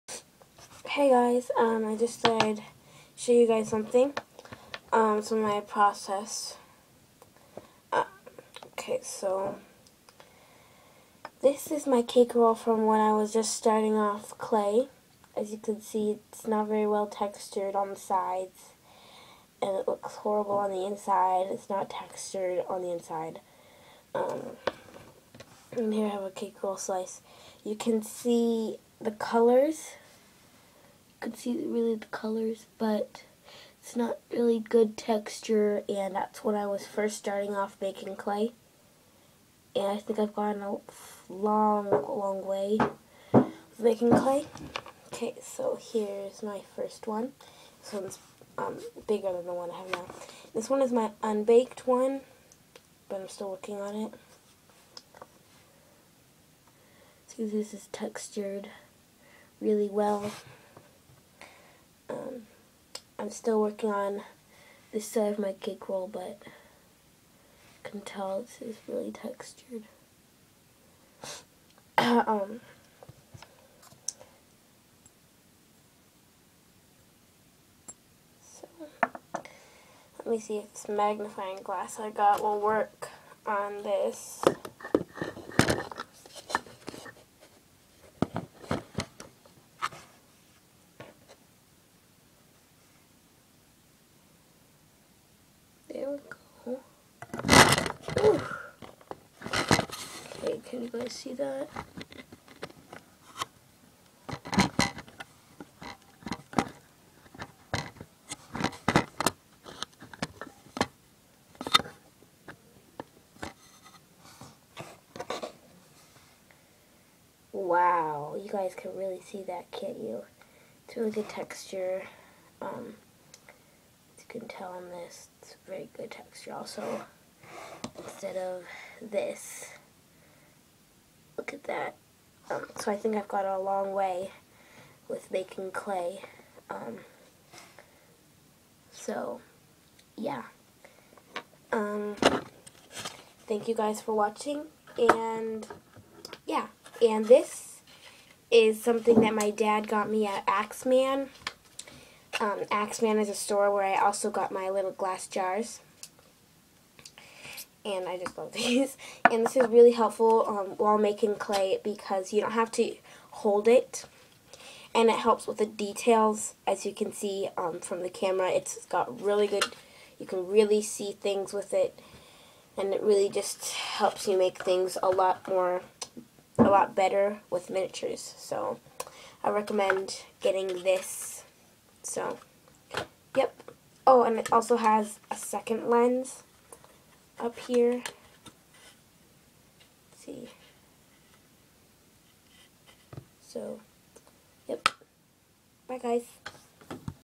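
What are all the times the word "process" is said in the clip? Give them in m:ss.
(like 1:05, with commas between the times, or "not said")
0:05.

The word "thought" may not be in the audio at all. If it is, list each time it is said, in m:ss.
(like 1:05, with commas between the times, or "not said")
0:02.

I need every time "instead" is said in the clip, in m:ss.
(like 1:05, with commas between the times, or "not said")
2:08.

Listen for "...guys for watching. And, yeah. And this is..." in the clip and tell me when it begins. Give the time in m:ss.
2:23.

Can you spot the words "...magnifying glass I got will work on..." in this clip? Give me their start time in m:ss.
1:20.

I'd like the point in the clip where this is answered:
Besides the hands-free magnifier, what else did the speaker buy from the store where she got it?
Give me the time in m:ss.
2:34.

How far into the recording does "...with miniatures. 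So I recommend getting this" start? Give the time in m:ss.
2:57.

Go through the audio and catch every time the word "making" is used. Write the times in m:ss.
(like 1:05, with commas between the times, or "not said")
0:37, 0:43, 2:15, 2:40.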